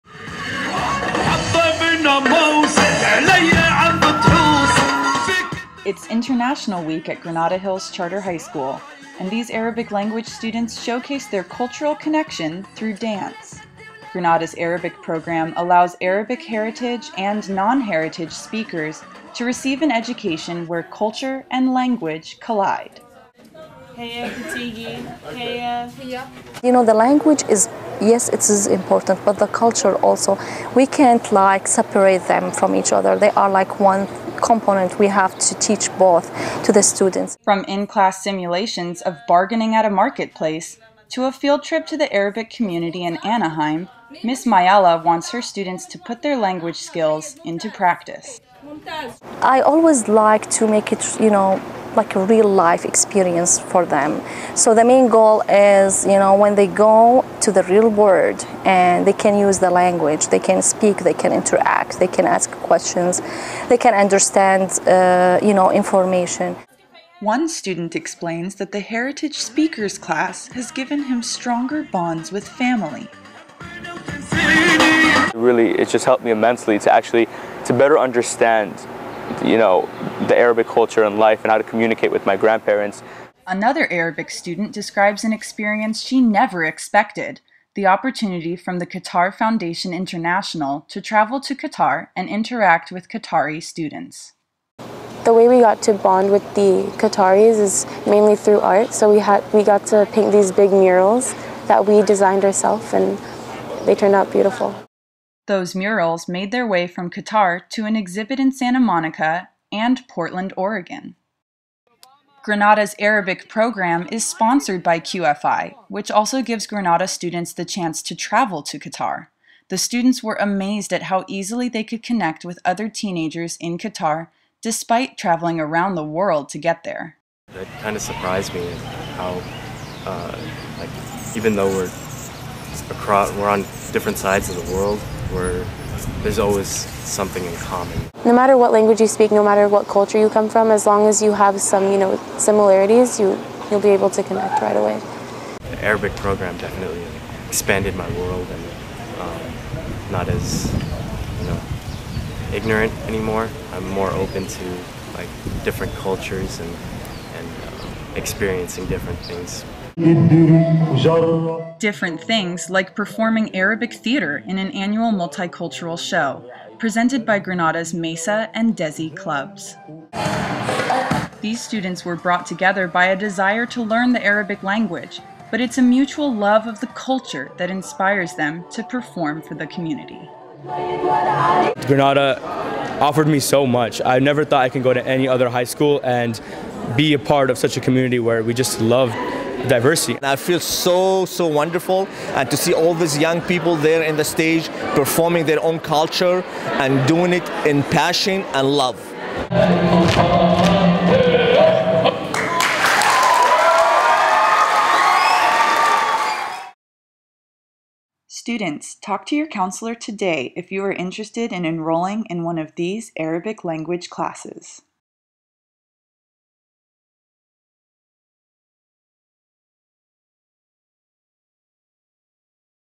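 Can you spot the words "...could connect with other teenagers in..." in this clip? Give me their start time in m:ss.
2:01.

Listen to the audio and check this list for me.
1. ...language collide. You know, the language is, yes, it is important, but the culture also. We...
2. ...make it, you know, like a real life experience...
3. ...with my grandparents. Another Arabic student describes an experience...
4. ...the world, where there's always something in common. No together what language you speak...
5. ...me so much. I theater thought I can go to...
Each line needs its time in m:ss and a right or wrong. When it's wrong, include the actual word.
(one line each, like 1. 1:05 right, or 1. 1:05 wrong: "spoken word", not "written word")
1. 0:21 right
2. 0:50 right
3. 1:22 right
4. 2:14 wrong: "matter", not "together"
5. 3:03 wrong: "never", not "theater".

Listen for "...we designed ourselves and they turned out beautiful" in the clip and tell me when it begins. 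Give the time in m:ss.
1:41.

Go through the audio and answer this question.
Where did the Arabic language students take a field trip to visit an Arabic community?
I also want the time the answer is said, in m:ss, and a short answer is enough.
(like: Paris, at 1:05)
Anaheim, at 0:43.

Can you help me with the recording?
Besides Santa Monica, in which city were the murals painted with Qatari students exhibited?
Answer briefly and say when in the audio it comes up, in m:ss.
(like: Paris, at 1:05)
Portland, Oregon, at 1:50.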